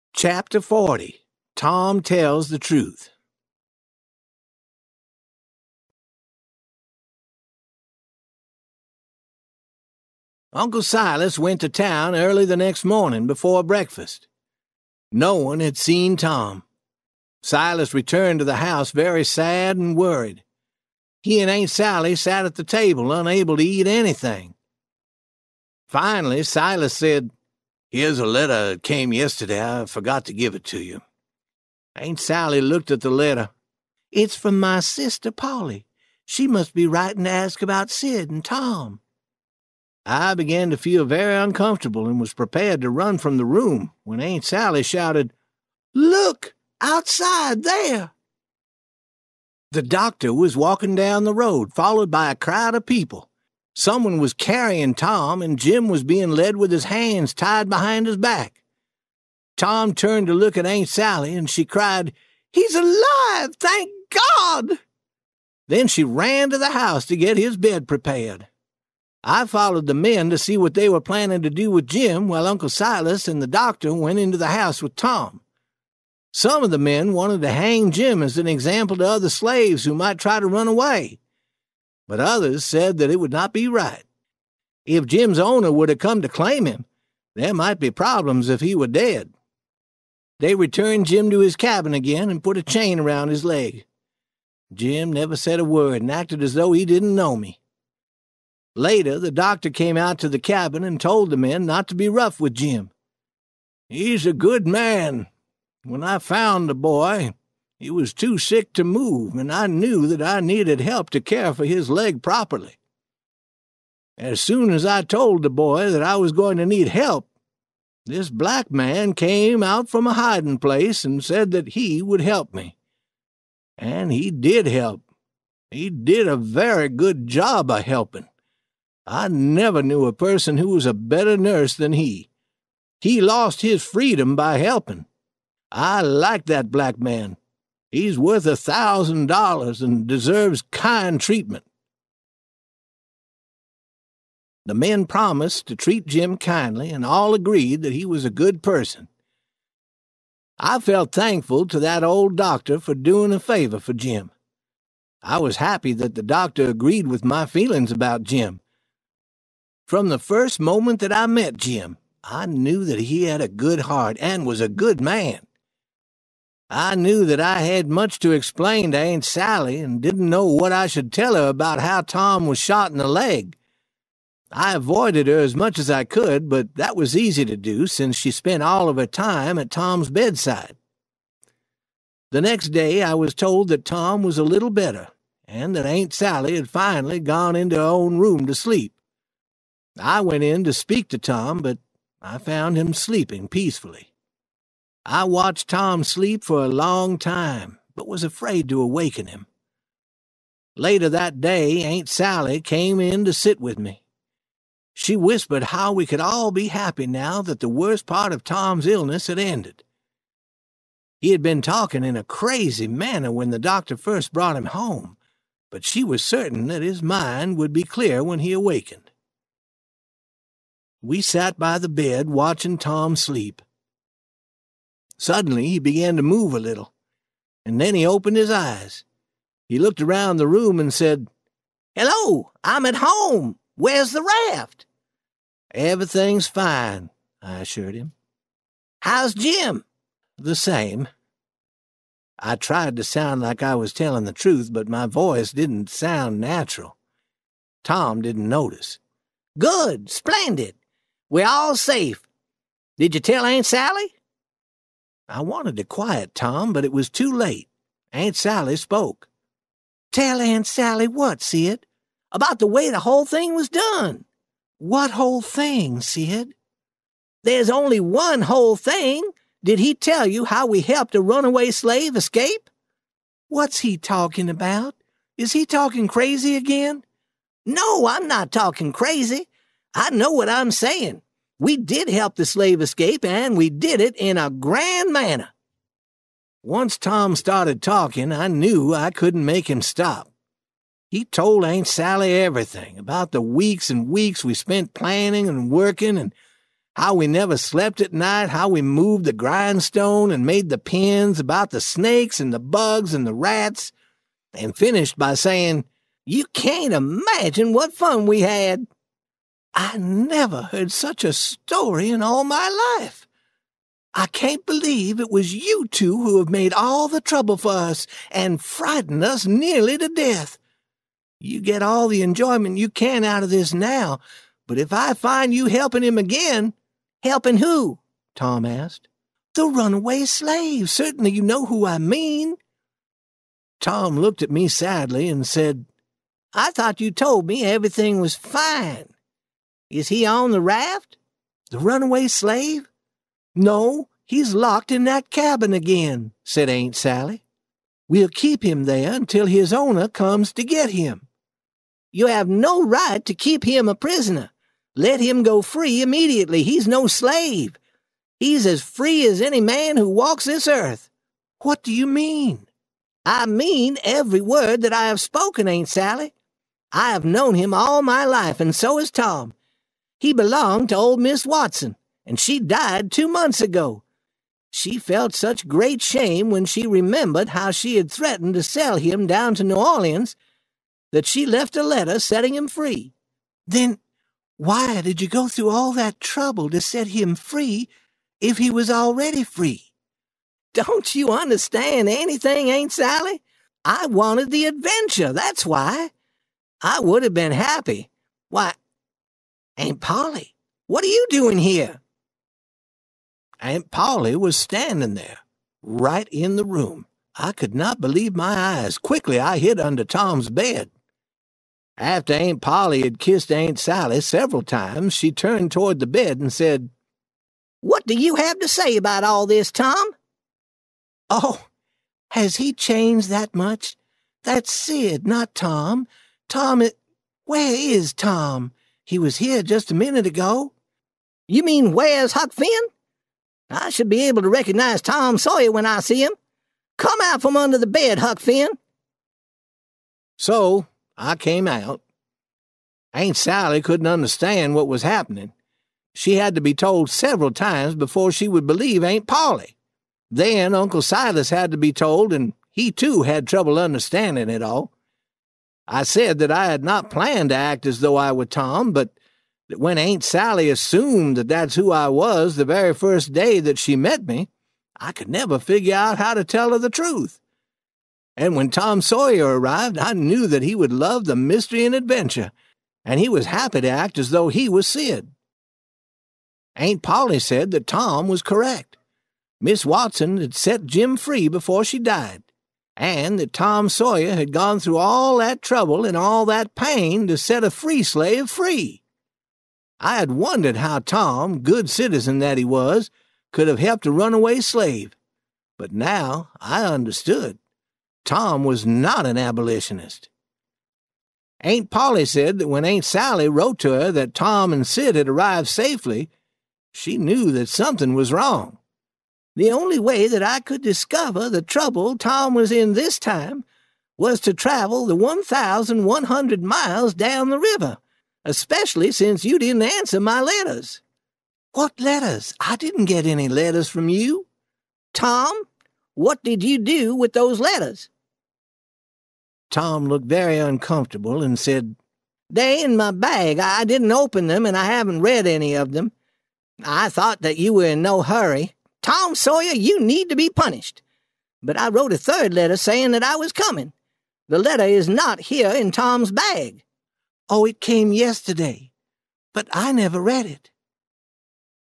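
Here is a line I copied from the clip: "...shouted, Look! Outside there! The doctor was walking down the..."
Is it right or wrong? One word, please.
right.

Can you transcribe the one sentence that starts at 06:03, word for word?
I mean every word that I have spoken, Aunt Sally.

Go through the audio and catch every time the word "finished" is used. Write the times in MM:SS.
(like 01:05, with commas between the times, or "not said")
05:04.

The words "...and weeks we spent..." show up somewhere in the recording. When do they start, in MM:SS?
04:53.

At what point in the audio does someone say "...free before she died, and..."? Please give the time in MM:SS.
08:01.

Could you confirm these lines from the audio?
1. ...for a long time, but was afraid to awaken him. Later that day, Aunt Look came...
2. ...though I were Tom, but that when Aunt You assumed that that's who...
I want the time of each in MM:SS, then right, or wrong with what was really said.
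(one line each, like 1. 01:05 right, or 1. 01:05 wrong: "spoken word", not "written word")
1. 03:16 wrong: "Sally", not "Look"
2. 07:37 wrong: "Sally", not "You".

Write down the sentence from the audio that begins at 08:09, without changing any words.
I had wondered how Tom, good citizen that he was, could have helped a runaway slave, but now I understood.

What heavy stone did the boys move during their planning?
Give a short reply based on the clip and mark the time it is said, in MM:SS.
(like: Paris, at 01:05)
The grindstone, at 04:59.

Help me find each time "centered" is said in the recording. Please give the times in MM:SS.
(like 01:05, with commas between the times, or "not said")
not said.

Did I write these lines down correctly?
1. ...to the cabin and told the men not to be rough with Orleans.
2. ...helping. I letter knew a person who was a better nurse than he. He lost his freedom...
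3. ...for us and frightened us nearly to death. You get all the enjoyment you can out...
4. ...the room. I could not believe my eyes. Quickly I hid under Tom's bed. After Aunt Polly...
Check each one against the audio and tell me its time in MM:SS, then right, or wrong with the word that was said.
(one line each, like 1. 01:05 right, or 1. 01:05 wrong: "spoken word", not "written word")
1. 01:40 wrong: "Jim", not "Orleans"
2. 02:07 wrong: "never", not "letter"
3. 05:17 right
4. 06:46 right.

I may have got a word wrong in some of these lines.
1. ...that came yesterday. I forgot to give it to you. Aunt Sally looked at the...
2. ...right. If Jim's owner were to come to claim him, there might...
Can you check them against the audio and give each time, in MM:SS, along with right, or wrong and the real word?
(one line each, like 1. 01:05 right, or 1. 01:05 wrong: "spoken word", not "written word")
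1. 00:28 right
2. 01:23 right.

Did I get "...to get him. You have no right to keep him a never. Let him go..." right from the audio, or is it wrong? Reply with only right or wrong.
wrong.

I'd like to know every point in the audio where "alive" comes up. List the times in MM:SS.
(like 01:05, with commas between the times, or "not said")
01:02.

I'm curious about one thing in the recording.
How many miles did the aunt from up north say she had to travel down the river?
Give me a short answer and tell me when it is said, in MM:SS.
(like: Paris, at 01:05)
1,100, at 08:35.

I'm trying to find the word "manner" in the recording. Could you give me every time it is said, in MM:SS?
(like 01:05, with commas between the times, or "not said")
03:32, 04:45.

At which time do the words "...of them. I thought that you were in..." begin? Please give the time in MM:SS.
08:55.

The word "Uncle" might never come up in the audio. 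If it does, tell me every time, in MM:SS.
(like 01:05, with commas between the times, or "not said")
00:10, 01:12, 07:30.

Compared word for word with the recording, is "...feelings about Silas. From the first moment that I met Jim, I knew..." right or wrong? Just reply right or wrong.
wrong.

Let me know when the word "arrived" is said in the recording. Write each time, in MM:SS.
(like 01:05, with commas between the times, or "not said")
07:49, 08:25.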